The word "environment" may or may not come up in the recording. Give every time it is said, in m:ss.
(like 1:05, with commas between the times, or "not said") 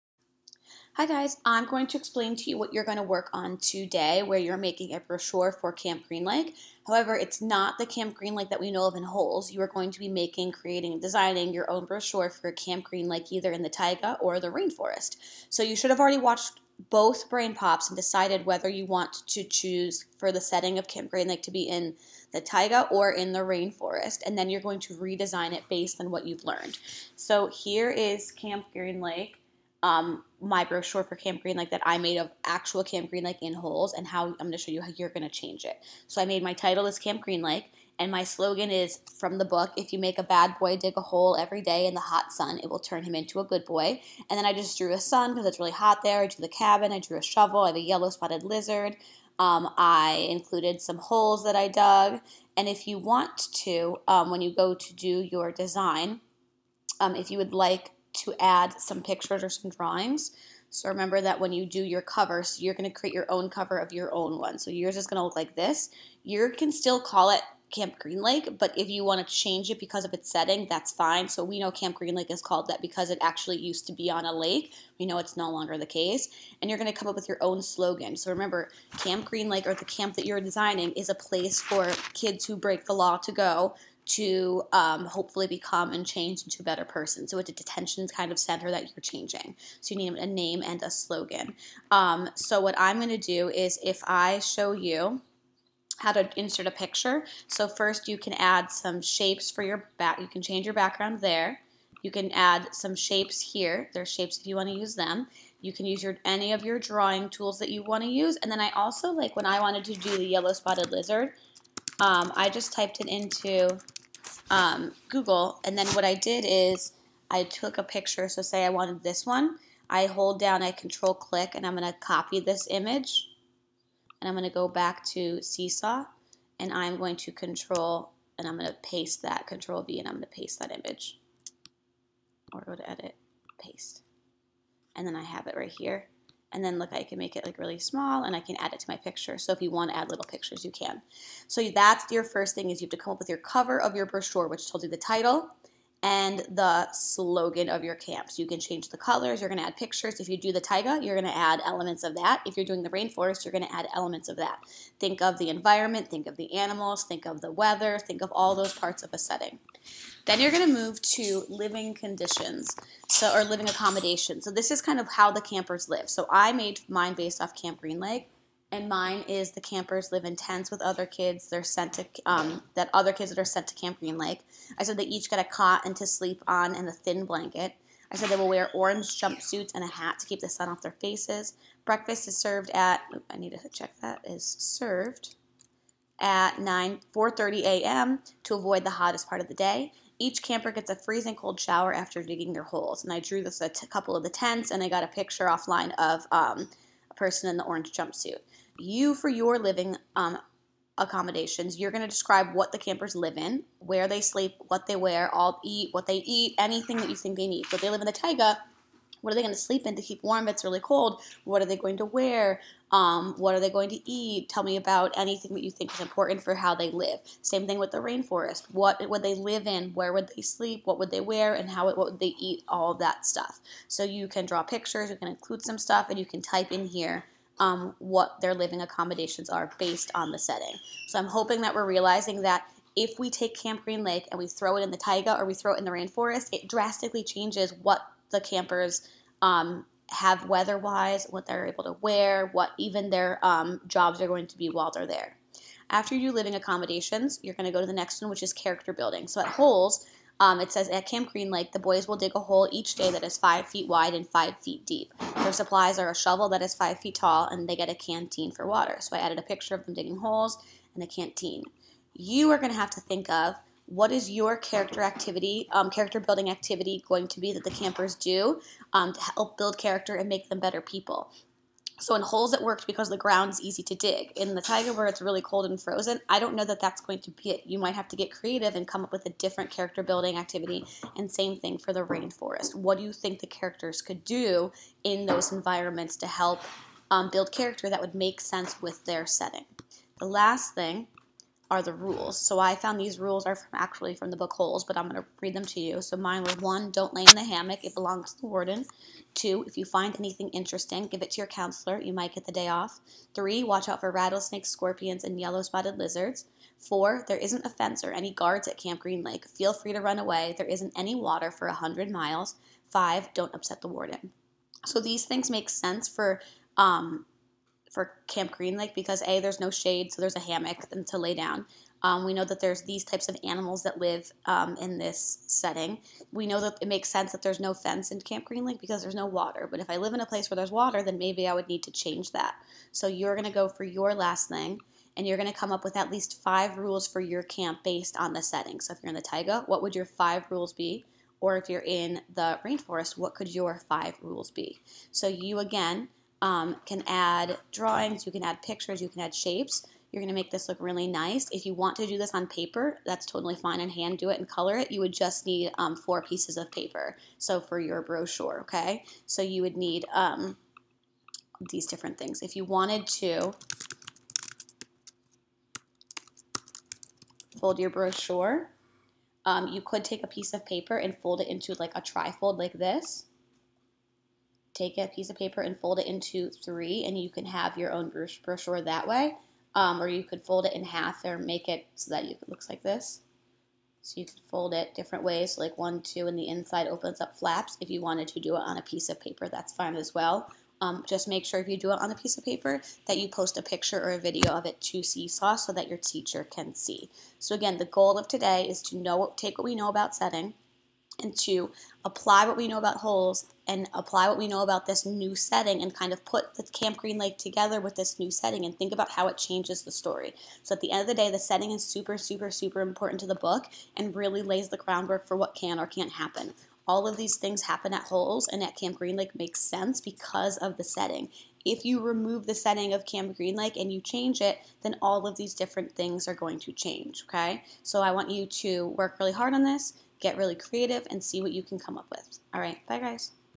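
2:35, 4:45.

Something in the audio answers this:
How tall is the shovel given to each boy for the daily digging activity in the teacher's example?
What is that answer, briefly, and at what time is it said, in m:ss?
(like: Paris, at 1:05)
5 feet, at 4:16.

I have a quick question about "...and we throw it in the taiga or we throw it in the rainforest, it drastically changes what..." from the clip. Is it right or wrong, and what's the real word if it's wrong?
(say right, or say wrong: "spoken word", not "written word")
right.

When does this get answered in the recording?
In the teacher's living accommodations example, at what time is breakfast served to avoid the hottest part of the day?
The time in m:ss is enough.
3:07.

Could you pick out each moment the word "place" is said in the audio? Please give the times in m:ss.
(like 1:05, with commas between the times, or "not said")
1:21, 5:30.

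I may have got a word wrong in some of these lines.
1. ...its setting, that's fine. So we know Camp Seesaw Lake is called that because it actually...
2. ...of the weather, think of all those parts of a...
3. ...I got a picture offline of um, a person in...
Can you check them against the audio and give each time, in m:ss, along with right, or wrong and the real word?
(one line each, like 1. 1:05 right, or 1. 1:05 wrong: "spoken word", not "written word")
1. 1:10 wrong: "Green", not "Seesaw"
2. 2:37 right
3. 3:14 right.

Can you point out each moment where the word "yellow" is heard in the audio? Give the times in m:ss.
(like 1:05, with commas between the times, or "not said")
0:47, 1:50, 5:05.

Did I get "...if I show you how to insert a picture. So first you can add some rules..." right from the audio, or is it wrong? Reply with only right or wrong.
wrong.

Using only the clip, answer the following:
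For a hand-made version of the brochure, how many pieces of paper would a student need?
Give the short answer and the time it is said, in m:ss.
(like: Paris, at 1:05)
4, at 5:55.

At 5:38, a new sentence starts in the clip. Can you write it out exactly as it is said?
So if you're in the taiga, what would your five rules be?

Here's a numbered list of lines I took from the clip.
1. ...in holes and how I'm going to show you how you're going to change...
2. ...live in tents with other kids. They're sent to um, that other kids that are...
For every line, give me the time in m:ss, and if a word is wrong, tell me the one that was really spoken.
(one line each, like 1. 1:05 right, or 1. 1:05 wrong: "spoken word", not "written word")
1. 0:33 right
2. 2:50 right.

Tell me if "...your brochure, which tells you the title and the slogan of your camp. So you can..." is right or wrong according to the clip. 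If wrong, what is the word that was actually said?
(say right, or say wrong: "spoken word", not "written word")
right.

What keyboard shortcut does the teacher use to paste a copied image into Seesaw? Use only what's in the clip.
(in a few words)
control V.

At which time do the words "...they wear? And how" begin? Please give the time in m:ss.
3:41.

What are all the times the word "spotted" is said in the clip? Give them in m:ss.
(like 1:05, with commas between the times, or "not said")
0:48, 1:50, 5:05.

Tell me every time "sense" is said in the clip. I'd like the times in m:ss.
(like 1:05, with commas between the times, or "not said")
4:48, 5:15, 5:27, 6:59.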